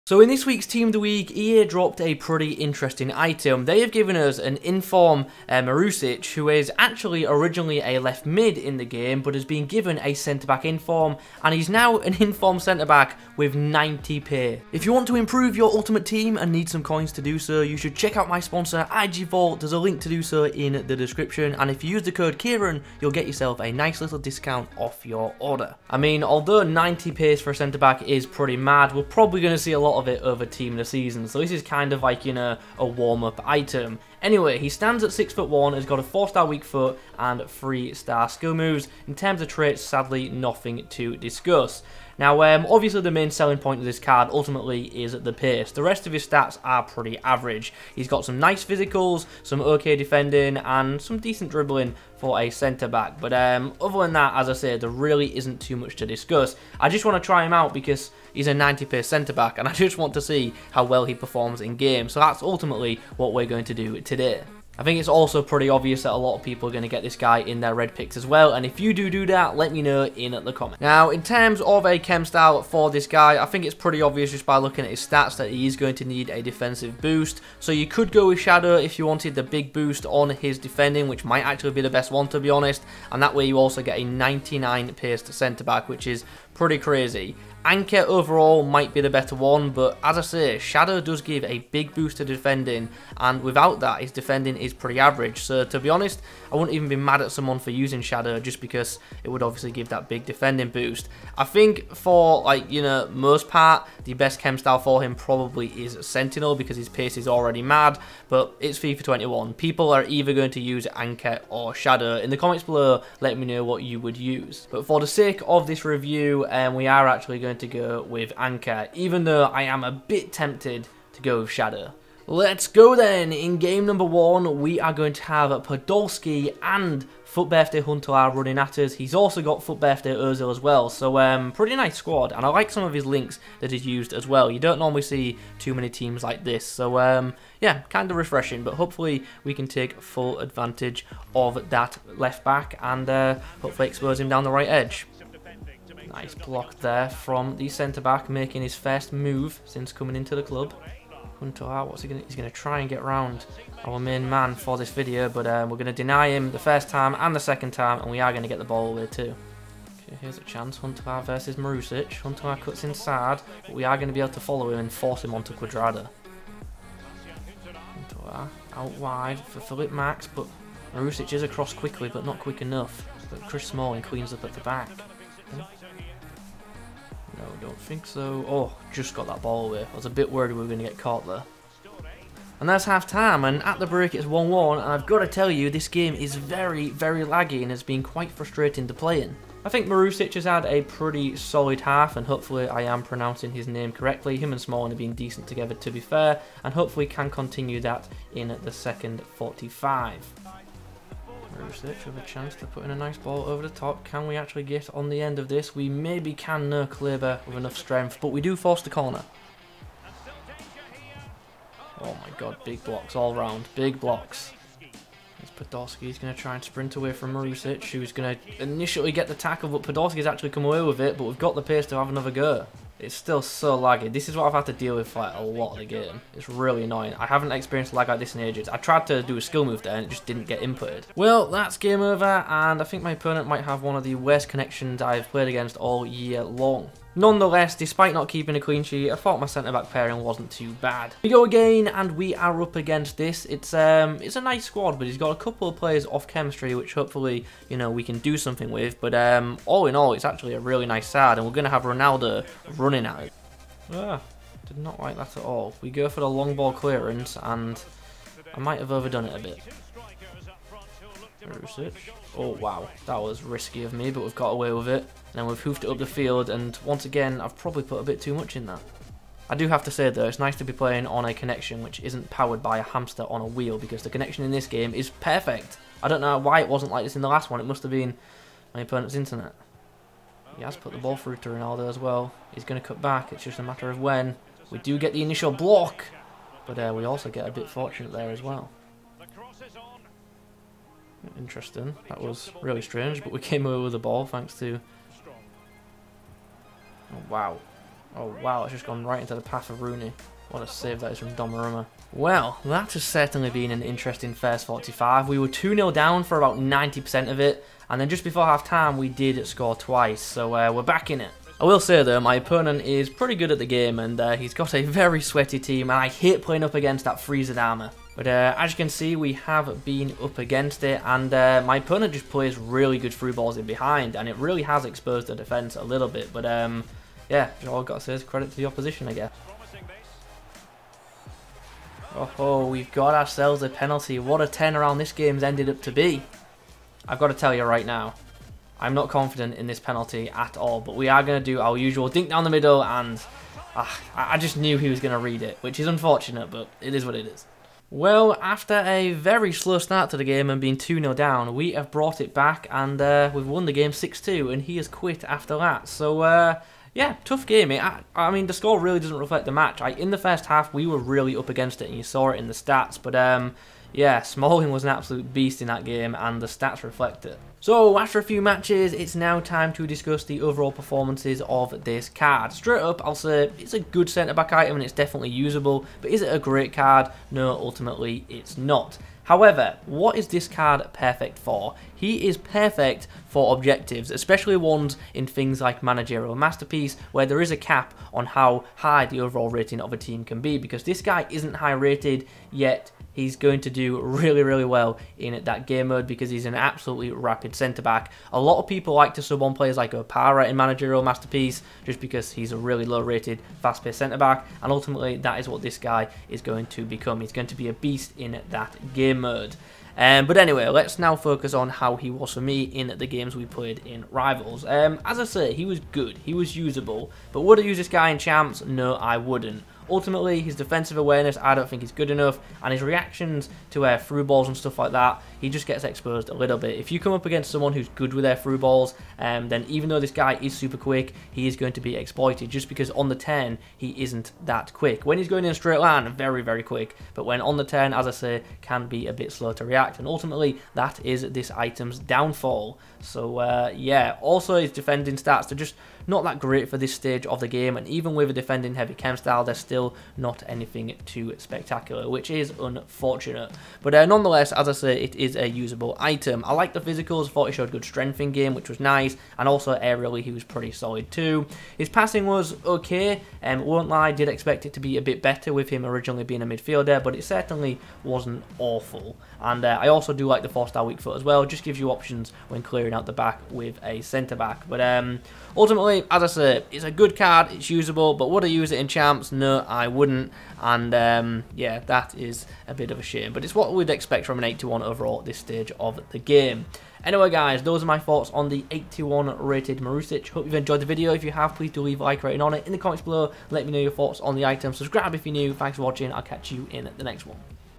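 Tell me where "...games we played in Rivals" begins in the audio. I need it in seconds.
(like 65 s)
413 s.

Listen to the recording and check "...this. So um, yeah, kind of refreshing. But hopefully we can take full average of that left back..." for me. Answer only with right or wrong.
wrong.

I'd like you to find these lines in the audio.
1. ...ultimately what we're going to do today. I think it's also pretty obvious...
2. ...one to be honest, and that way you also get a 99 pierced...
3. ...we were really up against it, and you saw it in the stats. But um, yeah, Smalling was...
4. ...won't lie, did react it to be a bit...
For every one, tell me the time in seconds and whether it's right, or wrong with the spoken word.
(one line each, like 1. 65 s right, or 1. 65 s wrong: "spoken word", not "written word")
1. 62 s right
2. 82 s right
3. 360 s right
4. 463 s wrong: "expect", not "react".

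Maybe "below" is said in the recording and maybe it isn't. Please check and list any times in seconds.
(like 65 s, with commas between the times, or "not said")
112 s, 493 s.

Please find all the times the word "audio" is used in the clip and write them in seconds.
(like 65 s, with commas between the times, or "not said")
not said.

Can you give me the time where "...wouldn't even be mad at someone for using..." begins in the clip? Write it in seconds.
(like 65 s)
96 s.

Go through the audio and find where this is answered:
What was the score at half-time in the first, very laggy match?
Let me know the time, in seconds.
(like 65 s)
184 s.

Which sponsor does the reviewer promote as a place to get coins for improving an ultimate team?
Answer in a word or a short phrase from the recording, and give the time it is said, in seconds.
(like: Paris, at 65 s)
IG Vault, at 18 s.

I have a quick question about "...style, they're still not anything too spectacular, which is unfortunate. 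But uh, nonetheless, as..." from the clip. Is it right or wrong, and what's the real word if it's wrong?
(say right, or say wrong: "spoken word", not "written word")
right.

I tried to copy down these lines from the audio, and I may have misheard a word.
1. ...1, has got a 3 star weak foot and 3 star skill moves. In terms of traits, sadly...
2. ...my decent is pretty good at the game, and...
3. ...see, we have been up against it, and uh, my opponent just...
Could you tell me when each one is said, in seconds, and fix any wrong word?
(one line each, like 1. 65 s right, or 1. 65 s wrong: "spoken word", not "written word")
1. 35 s wrong: "4", not "3"
2. 312 s wrong: "opponent", not "decent"
3. 318 s right.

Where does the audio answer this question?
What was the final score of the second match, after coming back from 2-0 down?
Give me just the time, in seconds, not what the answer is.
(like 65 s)
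353 s.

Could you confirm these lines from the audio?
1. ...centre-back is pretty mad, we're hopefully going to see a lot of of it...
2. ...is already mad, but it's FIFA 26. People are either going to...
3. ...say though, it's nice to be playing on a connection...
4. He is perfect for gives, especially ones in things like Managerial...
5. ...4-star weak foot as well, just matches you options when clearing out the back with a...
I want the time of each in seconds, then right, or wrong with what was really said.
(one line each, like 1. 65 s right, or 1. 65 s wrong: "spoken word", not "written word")
1. 27 s wrong: "probably", not "hopefully"
2. 107 s wrong: "21", not "26"
3. 269 s right
4. 381 s wrong: "objectives", not "gives"
5. 470 s wrong: "gives", not "matches".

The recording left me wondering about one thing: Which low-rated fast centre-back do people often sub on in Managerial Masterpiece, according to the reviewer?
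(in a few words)
Opara.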